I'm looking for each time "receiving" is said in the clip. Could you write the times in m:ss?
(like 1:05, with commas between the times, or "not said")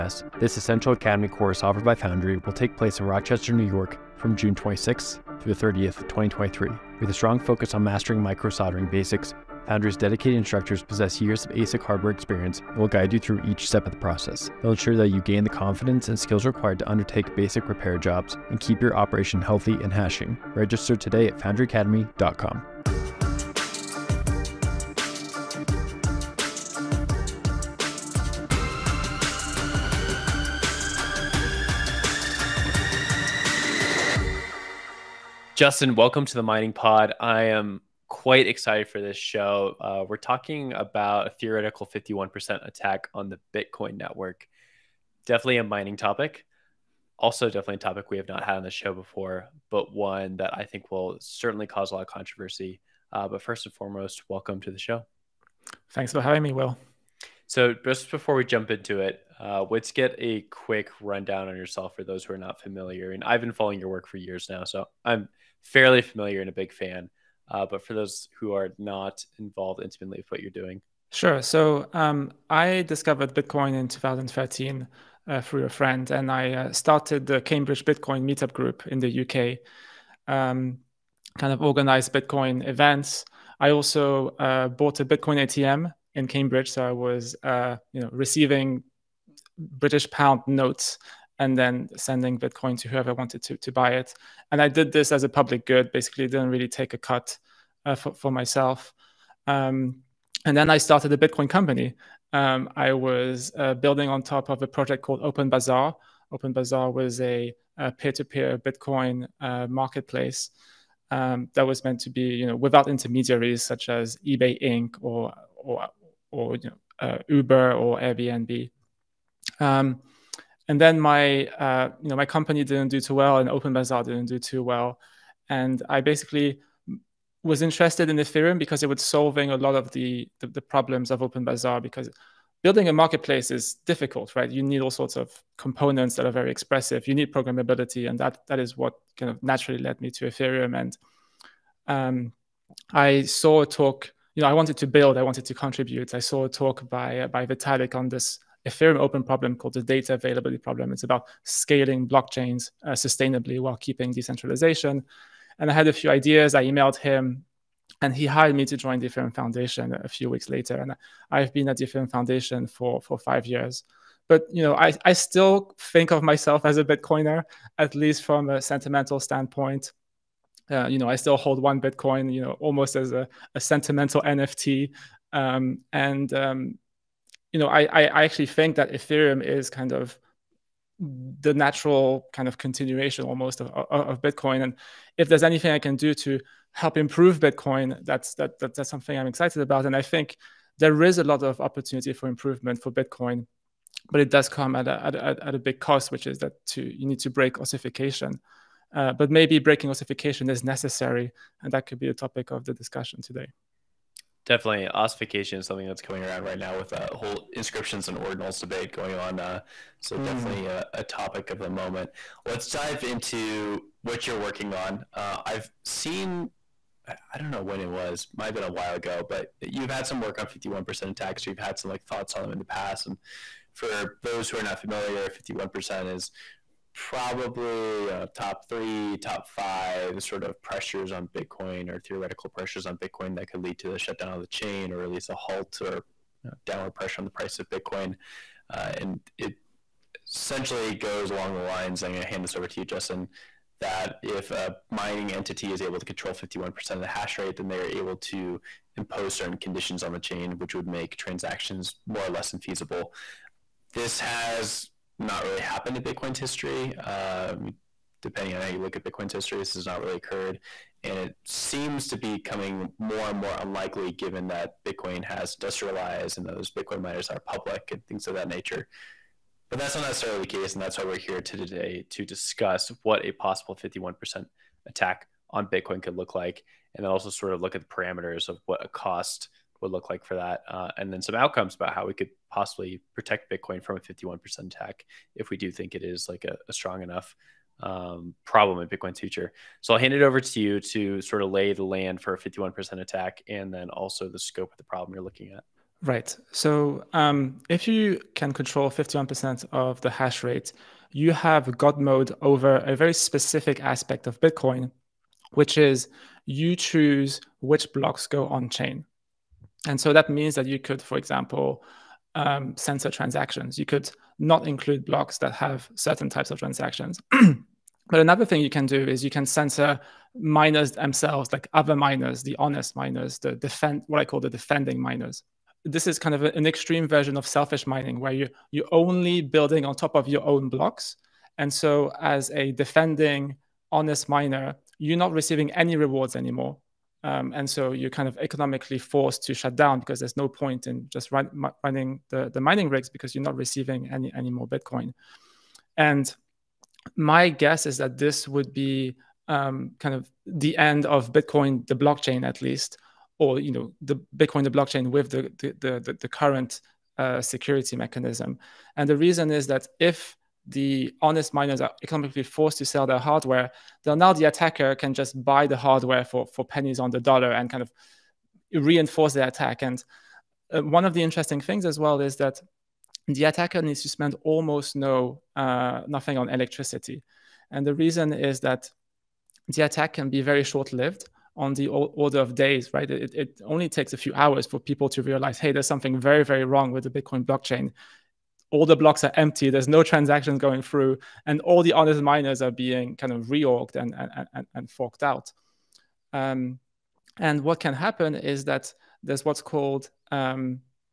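1:28, 5:35, 5:43.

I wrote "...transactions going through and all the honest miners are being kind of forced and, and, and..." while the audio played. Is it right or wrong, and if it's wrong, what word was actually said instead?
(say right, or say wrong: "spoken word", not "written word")
wrong: "reorged", not "forced".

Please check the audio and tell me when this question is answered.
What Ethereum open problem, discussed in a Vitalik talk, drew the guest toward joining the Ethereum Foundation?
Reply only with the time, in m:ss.
2:29.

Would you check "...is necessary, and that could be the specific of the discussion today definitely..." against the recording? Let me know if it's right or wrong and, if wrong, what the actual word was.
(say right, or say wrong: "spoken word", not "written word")
wrong: "topic", not "specific".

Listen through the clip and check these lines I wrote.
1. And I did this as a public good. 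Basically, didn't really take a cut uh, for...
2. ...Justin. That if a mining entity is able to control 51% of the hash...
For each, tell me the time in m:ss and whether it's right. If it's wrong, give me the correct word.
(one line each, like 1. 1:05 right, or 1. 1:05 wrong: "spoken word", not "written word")
1. 1:34 right
2. 4:02 right.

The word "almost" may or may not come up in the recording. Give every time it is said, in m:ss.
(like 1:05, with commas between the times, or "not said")
2:52, 3:03, 6:14.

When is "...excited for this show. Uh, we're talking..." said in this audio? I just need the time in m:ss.
0:38.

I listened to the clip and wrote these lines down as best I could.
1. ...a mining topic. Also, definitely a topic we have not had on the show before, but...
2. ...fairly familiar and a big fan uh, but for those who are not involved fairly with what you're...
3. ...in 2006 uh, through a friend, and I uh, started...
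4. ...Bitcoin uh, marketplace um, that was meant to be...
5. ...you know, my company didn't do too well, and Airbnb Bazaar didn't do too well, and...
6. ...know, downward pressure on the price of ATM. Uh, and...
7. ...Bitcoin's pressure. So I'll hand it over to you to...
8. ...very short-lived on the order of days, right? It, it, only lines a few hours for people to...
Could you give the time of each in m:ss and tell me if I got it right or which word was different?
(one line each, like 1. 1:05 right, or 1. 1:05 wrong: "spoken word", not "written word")
1. 0:45 right
2. 1:05 wrong: "intimately", not "fairly"
3. 1:13 wrong: "2013", not "2006"
4. 1:48 right
5. 2:02 wrong: "Open", not "Airbnb"
6. 3:56 wrong: "Bitcoin", not "ATM"
7. 4:48 wrong: "future", not "pressure"
8. 6:20 wrong: "takes", not "lines".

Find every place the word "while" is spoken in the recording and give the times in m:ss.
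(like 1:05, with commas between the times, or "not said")
2:33, 3:38.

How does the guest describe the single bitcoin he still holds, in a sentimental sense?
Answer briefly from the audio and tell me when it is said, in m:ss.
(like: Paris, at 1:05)
a sentimental NFT, at 2:53.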